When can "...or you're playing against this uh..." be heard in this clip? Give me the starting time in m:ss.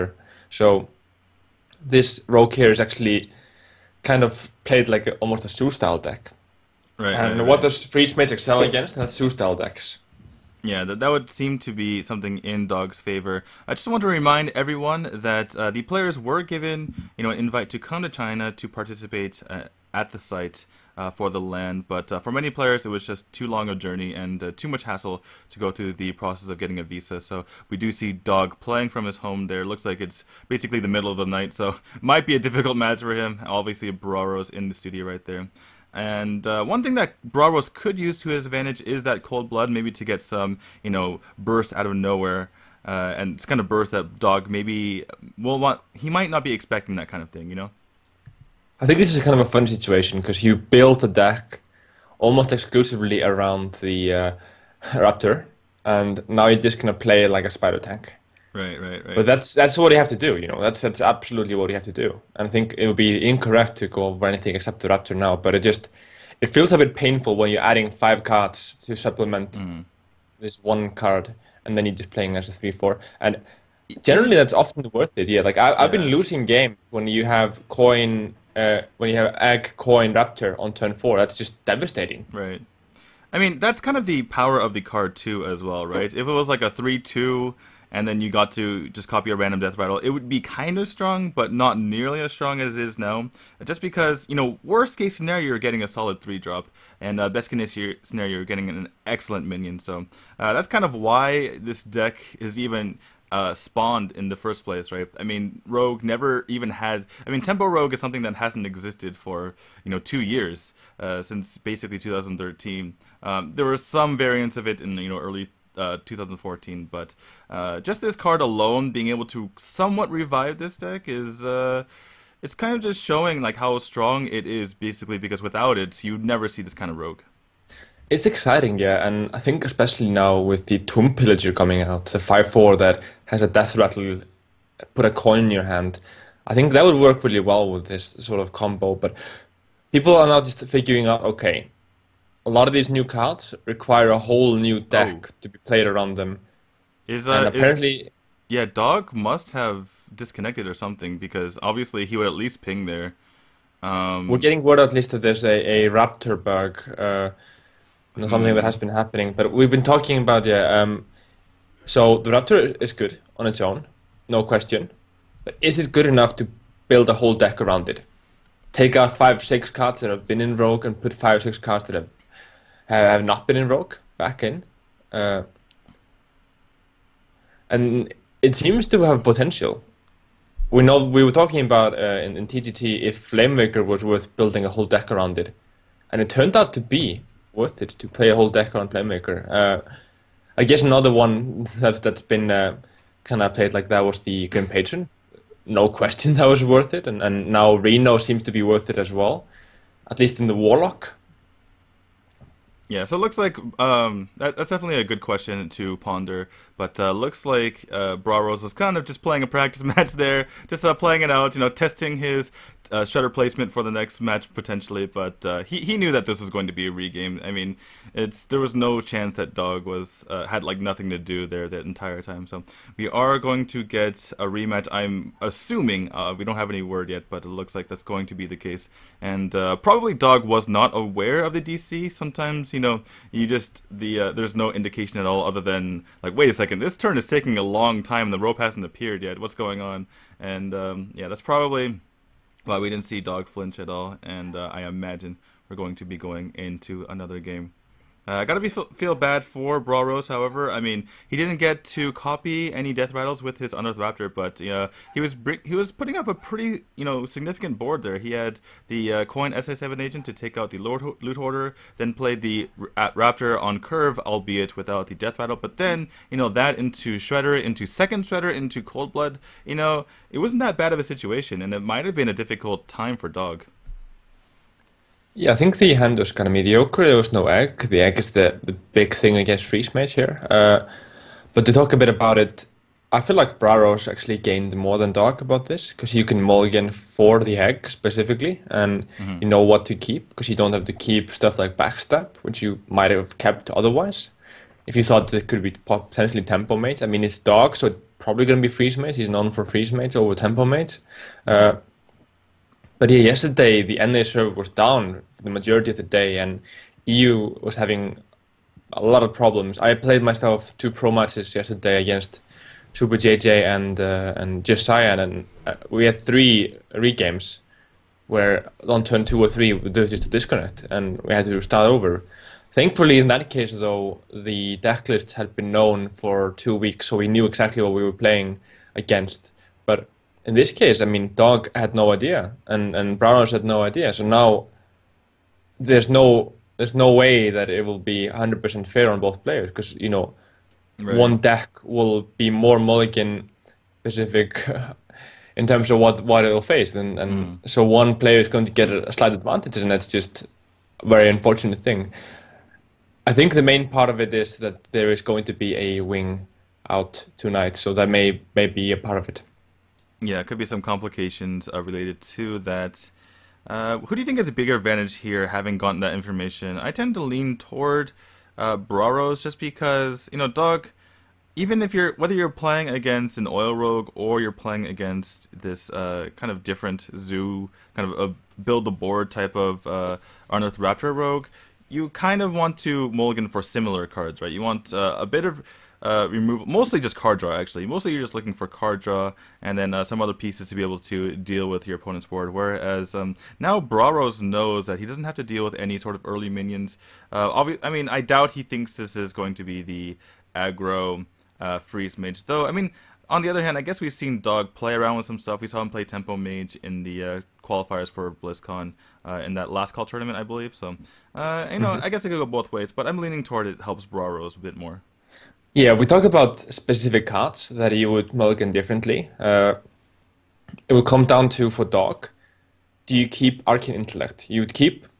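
6:14.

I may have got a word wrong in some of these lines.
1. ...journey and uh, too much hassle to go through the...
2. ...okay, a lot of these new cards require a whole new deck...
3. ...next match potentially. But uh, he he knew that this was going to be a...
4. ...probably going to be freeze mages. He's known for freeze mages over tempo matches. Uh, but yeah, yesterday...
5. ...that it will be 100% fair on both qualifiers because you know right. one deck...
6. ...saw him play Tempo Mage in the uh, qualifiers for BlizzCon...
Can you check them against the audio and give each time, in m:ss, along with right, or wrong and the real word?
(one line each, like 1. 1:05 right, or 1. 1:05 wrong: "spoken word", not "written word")
1. 0:23 right
2. 2:21 right
3. 3:33 right
4. 4:58 wrong: "mages", not "matches"
5. 5:37 wrong: "players", not "qualifiers"
6. 6:45 right.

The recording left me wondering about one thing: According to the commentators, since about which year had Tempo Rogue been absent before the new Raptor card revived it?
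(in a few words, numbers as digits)
2013.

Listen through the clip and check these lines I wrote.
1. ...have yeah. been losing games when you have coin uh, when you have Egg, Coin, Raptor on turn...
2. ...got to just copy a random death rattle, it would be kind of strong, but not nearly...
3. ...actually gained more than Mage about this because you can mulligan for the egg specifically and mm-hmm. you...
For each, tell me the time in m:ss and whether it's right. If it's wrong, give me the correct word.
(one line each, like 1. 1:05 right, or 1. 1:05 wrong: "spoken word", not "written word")
1. 1:15 right
2. 1:28 right
3. 4:44 wrong: "Dog", not "Mage".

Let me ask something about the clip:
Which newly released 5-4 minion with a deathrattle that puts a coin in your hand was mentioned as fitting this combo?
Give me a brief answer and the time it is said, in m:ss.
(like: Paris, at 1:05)
Tomb Pillager, at 2:10.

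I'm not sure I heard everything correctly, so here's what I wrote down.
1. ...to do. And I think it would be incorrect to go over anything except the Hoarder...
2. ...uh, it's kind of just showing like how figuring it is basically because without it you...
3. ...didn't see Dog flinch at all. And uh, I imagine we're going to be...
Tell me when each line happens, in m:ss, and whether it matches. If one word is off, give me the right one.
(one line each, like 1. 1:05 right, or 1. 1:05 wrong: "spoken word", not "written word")
1. 1:01 wrong: "Raptor", not "Hoarder"
2. 2:01 wrong: "strong", not "figuring"
3. 4:02 right.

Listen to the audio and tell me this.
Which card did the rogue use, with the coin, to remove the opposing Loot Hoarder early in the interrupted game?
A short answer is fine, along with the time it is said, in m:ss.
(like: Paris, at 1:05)
SI7 Agent, at 4:19.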